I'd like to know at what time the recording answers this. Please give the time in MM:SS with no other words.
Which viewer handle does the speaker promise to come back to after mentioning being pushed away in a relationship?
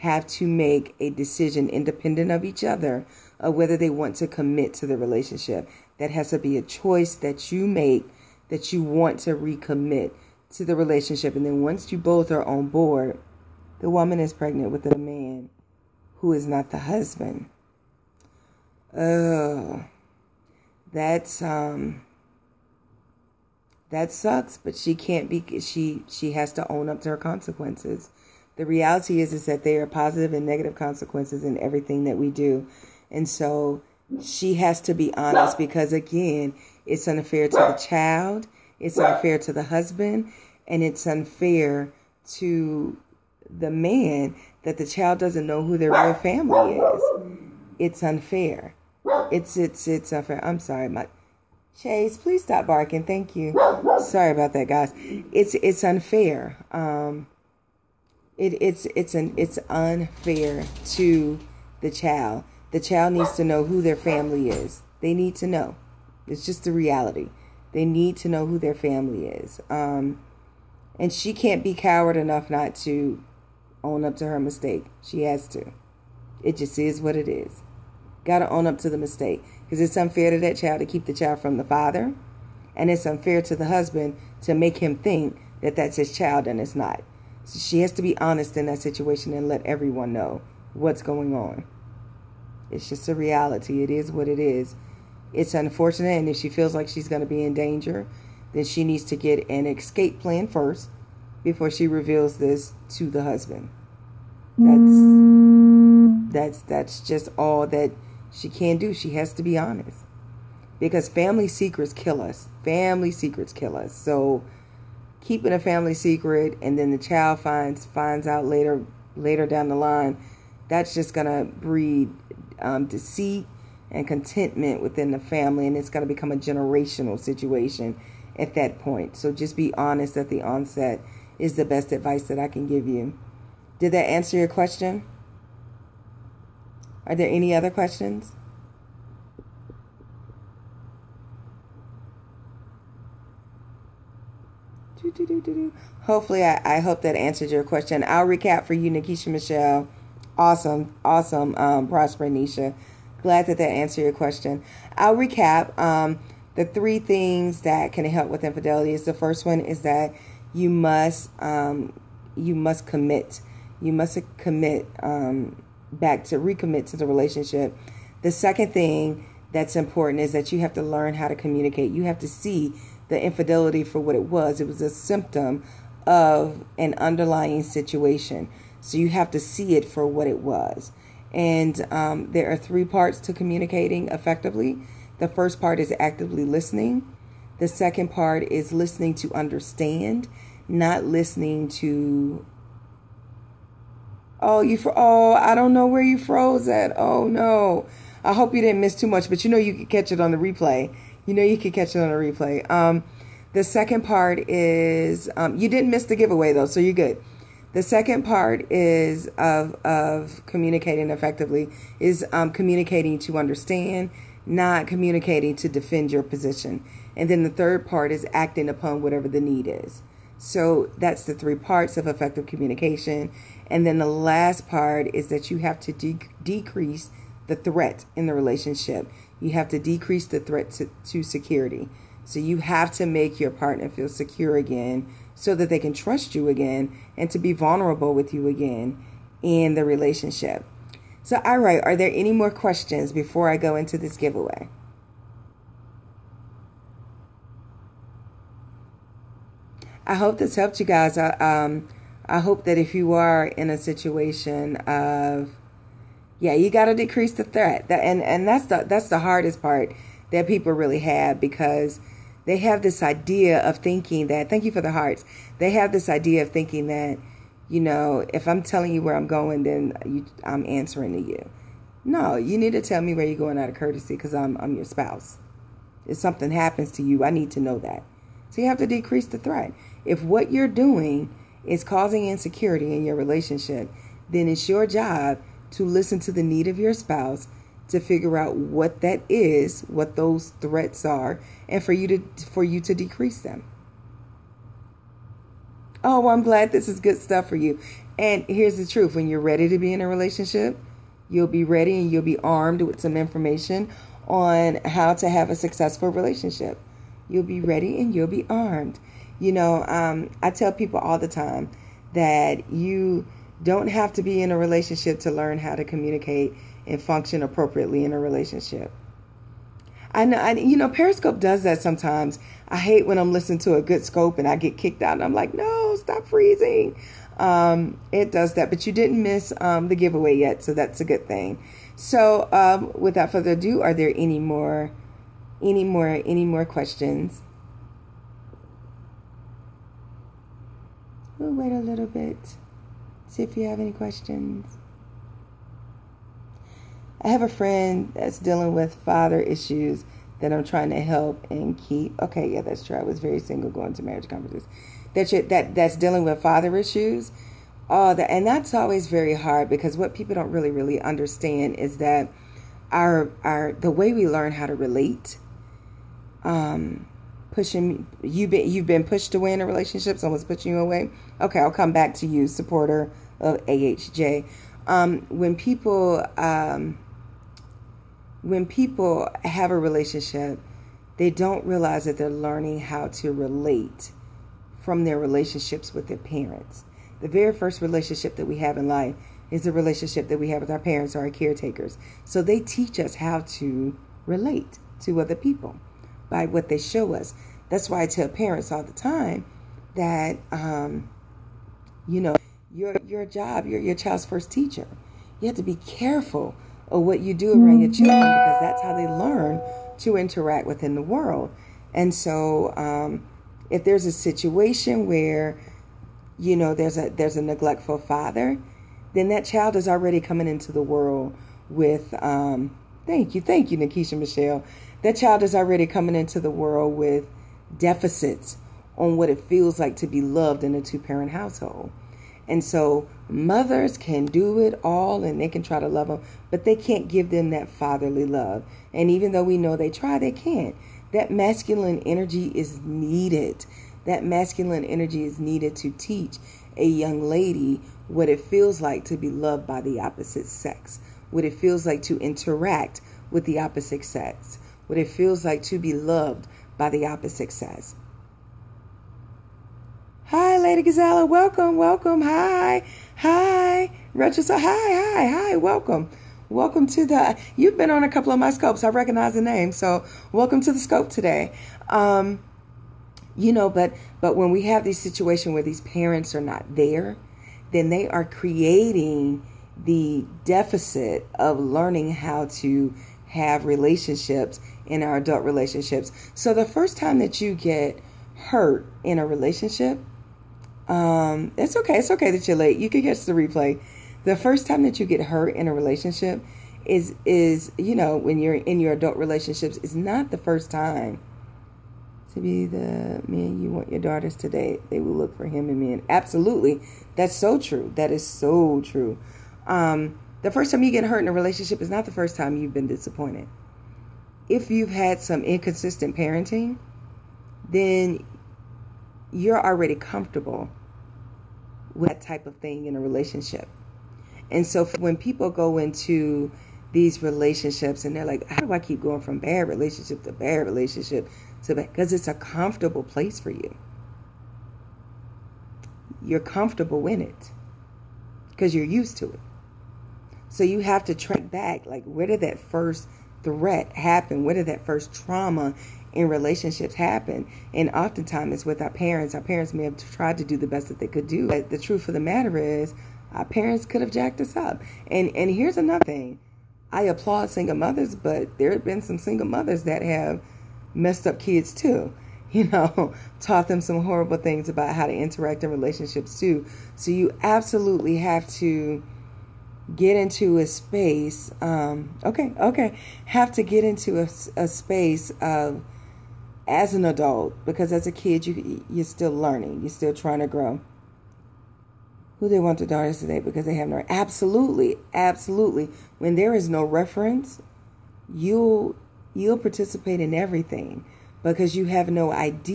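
06:12.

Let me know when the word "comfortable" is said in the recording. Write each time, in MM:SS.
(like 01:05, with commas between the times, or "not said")
08:39, 08:52, 08:56.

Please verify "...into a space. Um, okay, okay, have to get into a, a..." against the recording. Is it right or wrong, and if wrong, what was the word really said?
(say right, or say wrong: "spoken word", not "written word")
right.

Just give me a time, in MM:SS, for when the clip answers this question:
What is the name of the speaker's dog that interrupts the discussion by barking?
00:51.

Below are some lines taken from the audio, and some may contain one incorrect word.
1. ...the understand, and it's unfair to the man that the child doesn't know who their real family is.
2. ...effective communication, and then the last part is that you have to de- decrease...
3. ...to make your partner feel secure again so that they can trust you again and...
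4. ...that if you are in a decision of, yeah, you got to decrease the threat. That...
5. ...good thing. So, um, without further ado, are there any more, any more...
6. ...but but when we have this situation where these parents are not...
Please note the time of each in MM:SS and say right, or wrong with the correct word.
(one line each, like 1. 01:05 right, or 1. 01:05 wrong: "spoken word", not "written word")
1. 00:39 wrong: "husband", not "understand"
2. 03:42 right
3. 03:52 right
4. 04:12 wrong: "situation", not "decision"
5. 05:31 right
6. 07:53 right.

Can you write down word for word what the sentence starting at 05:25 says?
And I'm like, no, stop freezing.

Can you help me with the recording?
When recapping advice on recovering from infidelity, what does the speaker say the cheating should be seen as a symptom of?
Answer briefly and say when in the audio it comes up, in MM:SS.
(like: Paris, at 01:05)
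An underlying situation, at 02:56.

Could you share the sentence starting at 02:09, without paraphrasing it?
So just be honest at the onset is the best advice that I can give you.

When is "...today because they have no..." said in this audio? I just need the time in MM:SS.
09:43.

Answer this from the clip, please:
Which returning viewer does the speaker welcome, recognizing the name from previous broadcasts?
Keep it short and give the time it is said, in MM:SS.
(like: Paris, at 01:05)
Lady Gazella, at 07:40.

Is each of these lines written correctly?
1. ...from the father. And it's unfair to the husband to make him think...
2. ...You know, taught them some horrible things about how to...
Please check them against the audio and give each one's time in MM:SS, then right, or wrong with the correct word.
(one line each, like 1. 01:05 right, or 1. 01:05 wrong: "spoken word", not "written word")
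1. 01:21 right
2. 09:22 right.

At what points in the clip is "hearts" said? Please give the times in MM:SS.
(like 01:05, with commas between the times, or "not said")
04:24.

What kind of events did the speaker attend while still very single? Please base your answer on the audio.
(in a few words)
Marriage conferences.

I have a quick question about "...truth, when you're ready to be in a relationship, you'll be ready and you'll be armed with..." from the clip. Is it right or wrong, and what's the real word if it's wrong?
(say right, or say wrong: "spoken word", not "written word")
right.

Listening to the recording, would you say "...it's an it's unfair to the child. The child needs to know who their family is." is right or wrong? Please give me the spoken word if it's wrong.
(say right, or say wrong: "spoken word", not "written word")
right.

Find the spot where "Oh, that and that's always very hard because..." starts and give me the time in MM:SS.
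05:57.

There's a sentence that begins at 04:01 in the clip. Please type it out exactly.
So, all right, are there any more questions before I go into this giveaway?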